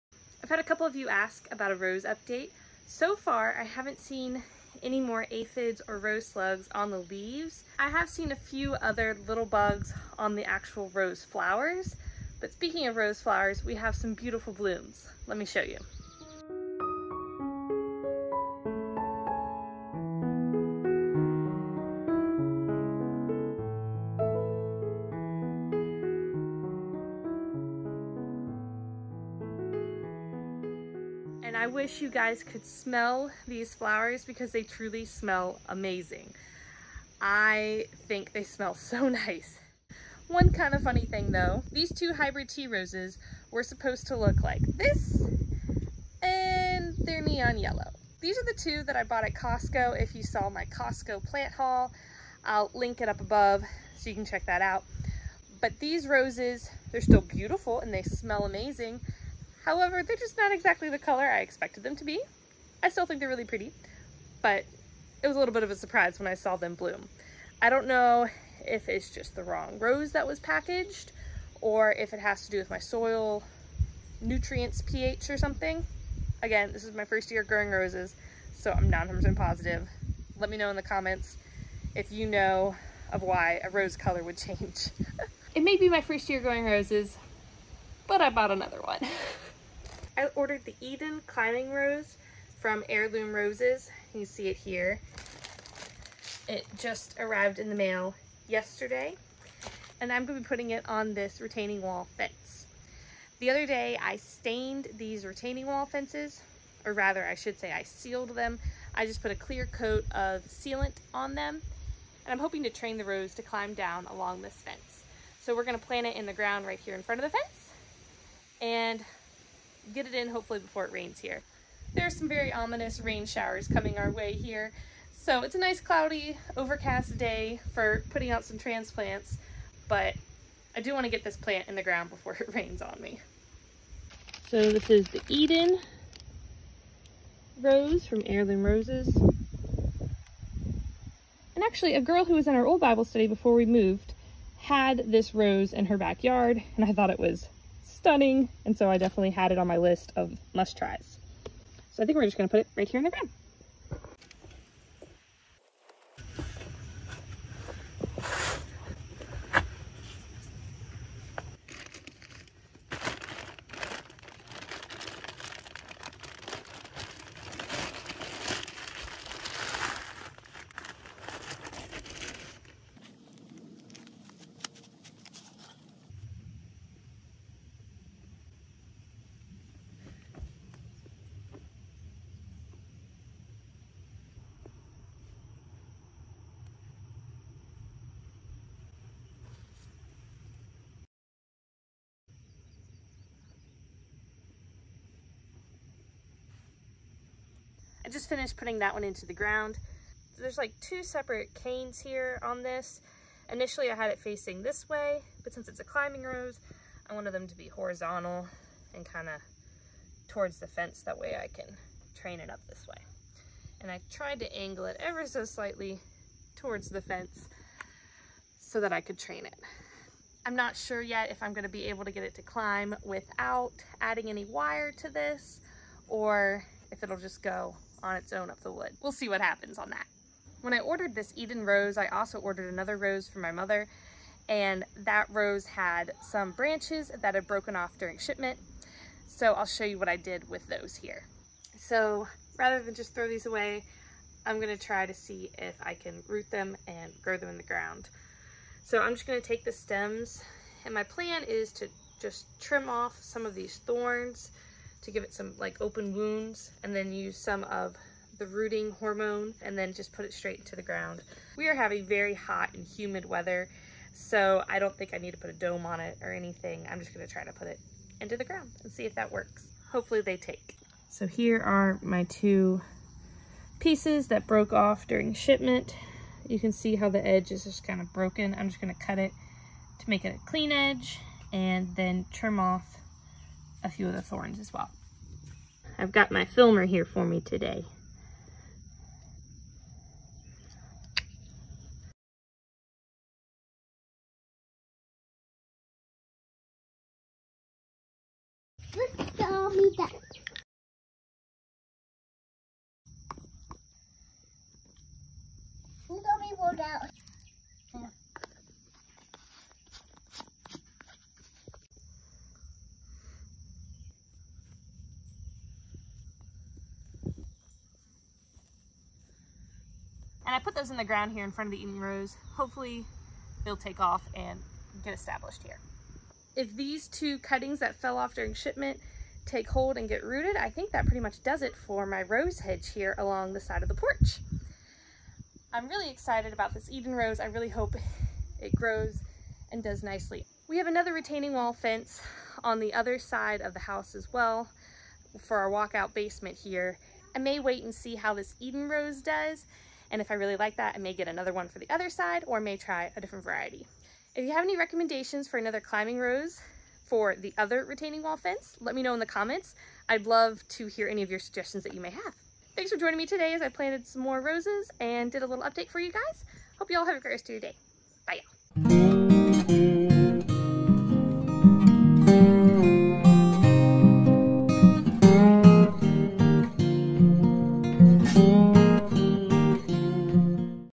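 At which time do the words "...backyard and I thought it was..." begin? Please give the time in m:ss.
2:25.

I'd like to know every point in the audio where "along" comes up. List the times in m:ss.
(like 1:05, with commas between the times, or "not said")
1:54, 5:33.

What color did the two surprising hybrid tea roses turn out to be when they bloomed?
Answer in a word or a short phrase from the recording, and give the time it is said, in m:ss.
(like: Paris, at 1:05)
Neon yellow, at 0:47.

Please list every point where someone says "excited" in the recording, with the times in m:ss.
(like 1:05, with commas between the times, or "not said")
5:36.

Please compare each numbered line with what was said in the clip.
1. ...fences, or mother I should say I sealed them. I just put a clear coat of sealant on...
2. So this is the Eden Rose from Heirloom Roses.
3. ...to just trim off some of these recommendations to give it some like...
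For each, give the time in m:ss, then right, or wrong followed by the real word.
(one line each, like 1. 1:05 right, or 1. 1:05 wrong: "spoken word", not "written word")
1. 1:45 wrong: "rather", not "mother"
2. 2:14 right
3. 4:11 wrong: "thorns", not "recommendations".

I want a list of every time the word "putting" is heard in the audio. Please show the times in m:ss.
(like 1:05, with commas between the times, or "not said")
1:40, 2:08, 3:18.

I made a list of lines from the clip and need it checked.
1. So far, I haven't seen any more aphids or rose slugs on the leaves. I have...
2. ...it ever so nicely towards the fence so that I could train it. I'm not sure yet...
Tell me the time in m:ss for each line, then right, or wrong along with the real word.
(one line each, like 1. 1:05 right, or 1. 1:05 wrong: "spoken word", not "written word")
1. 0:02 right
2. 3:34 wrong: "slightly", not "nicely".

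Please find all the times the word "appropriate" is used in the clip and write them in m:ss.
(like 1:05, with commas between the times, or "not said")
not said.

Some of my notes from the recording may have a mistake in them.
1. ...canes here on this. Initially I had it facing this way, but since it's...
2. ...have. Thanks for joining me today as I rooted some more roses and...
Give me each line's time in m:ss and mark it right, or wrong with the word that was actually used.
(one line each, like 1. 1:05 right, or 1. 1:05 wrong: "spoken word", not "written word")
1. 3:21 right
2. 6:02 wrong: "planted", not "rooted".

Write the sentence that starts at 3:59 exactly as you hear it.
So I'll show you what I did with those here.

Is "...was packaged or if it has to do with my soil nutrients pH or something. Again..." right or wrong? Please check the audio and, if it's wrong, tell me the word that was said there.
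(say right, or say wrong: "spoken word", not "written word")
right.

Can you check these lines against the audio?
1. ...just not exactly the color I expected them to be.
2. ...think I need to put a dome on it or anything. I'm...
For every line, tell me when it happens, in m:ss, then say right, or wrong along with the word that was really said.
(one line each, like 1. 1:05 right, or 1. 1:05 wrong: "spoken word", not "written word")
1. 1:00 right
2. 4:24 right.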